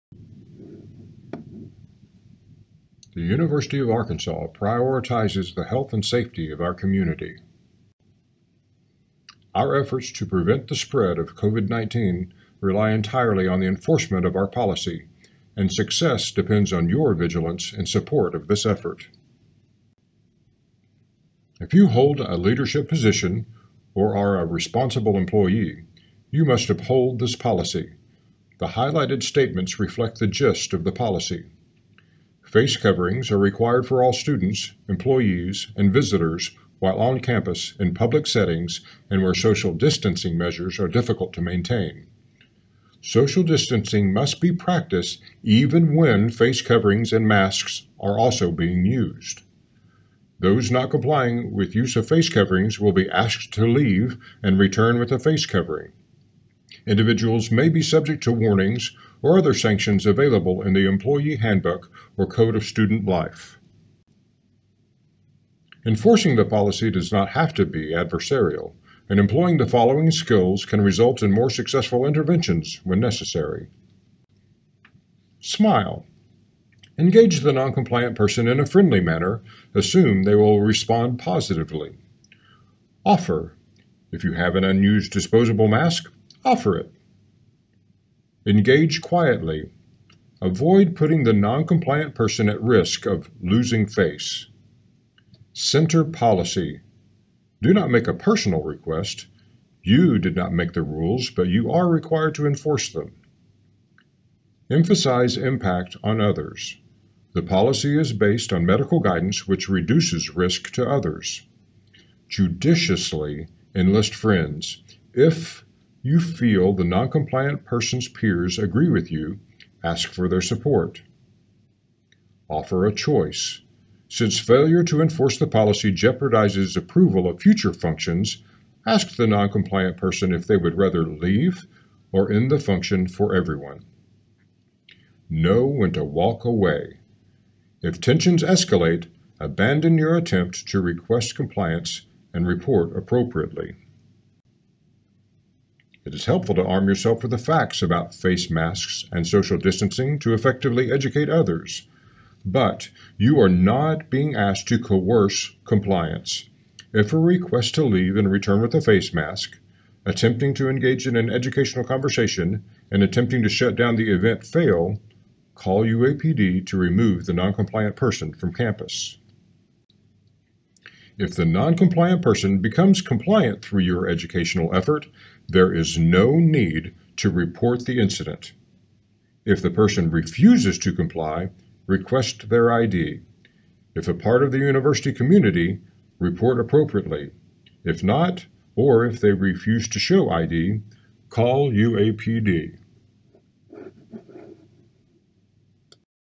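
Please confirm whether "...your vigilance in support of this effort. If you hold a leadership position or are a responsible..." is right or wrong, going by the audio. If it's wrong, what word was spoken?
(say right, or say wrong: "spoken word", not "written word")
right.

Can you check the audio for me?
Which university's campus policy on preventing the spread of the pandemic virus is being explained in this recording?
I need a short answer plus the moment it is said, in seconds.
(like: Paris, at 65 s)
University of Arkansas, at 3 s.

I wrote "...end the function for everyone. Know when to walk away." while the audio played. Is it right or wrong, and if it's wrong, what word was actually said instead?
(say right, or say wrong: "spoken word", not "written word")
right.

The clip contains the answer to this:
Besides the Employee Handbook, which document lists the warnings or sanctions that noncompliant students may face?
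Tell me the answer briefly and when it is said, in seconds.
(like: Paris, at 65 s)
Code of Student Life, at 62 s.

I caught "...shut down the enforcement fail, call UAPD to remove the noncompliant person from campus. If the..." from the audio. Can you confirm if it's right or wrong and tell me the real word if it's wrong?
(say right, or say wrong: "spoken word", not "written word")
wrong: "event", not "enforcement".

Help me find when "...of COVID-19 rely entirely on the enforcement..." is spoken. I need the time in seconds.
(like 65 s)
11 s.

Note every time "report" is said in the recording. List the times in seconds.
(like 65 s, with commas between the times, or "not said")
142 s, 177 s, 186 s.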